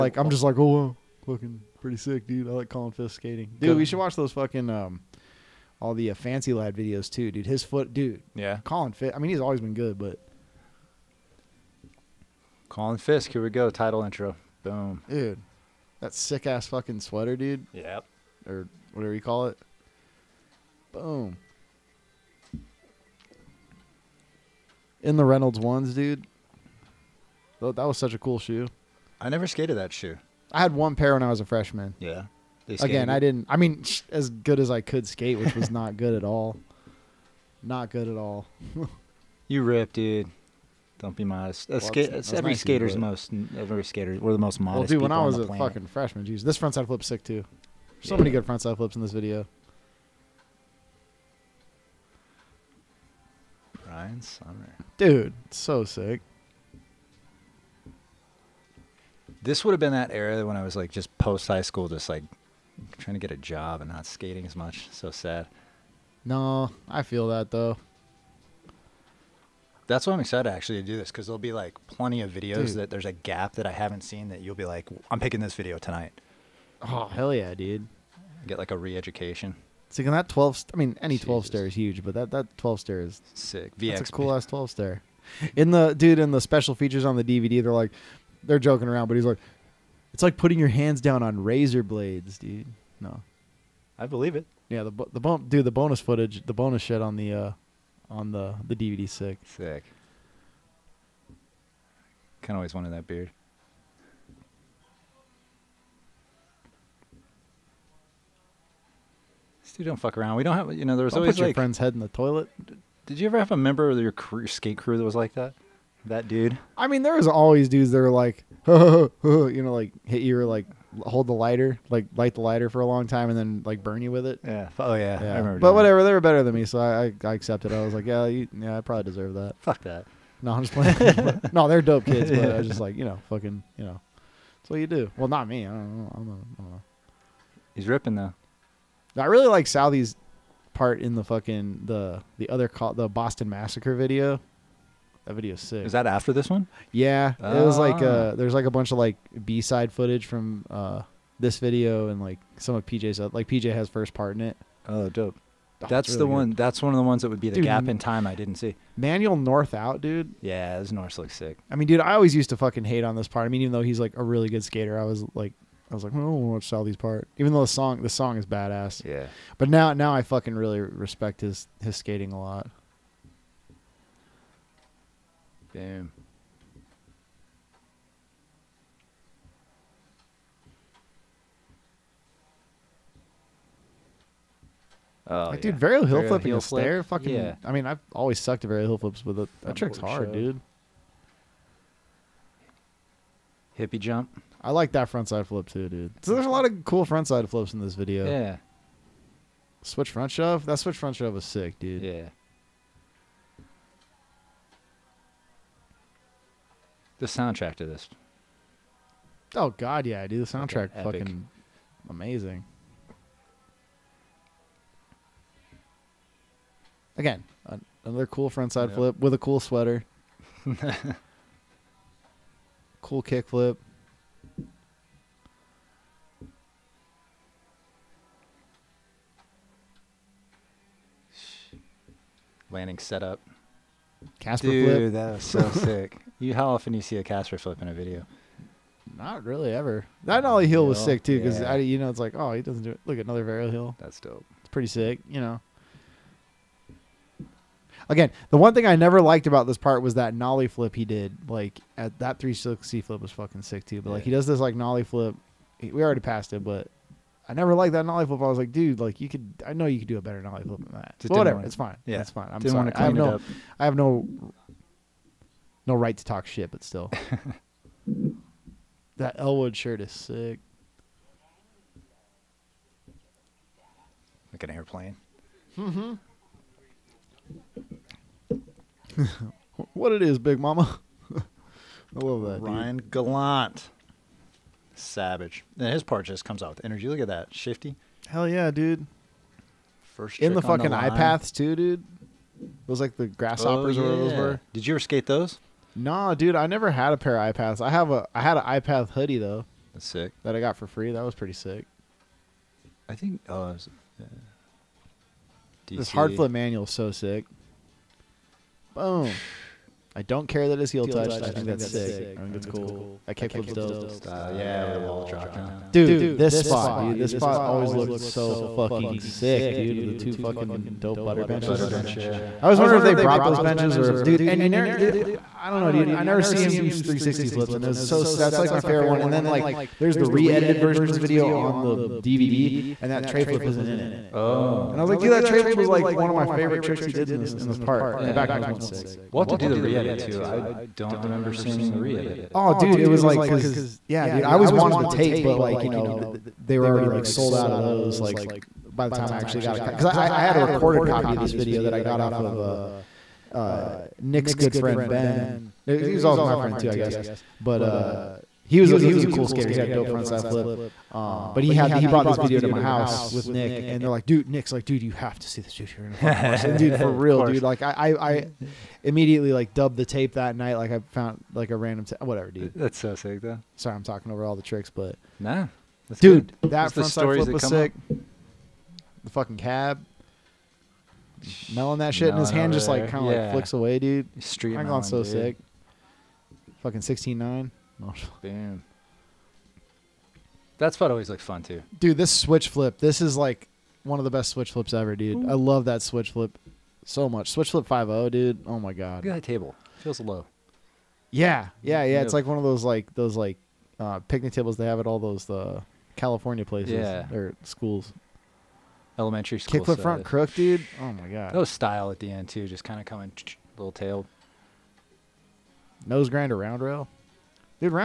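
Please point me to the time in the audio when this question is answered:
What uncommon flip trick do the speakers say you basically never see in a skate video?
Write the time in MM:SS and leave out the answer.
03:57.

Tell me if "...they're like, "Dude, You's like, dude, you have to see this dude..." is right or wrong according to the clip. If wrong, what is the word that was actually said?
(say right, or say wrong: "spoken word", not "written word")
wrong: "Nick", not "You".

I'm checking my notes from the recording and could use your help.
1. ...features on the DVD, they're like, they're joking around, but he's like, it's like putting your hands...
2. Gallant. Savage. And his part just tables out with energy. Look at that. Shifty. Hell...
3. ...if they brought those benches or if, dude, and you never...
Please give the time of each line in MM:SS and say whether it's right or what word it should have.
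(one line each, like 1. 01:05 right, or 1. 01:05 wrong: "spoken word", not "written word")
1. 01:26 right
2. 04:43 wrong: "comes", not "tables"
3. 05:22 right.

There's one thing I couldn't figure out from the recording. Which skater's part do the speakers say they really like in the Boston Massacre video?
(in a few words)
Southie.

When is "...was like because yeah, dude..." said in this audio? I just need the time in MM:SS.
05:43.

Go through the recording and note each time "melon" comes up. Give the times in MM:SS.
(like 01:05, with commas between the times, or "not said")
06:21.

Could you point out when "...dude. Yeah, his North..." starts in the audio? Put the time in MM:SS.
02:40.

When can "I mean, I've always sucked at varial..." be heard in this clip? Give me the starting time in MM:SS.
03:07.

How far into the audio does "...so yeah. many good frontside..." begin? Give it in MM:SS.
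00:48.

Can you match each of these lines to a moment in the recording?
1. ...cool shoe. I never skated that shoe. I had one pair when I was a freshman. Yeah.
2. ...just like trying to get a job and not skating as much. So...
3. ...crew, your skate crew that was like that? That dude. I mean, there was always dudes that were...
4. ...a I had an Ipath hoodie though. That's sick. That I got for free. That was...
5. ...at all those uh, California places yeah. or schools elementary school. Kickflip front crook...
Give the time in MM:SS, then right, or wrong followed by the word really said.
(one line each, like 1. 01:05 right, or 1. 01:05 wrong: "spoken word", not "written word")
1. 00:28 right
2. 01:01 right
3. 01:54 right
4. 04:58 right
5. 06:44 right.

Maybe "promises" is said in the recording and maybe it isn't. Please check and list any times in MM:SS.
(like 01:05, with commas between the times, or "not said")
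not said.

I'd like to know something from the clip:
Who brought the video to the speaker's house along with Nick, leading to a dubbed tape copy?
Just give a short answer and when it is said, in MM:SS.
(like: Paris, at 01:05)
Ben, at 05:55.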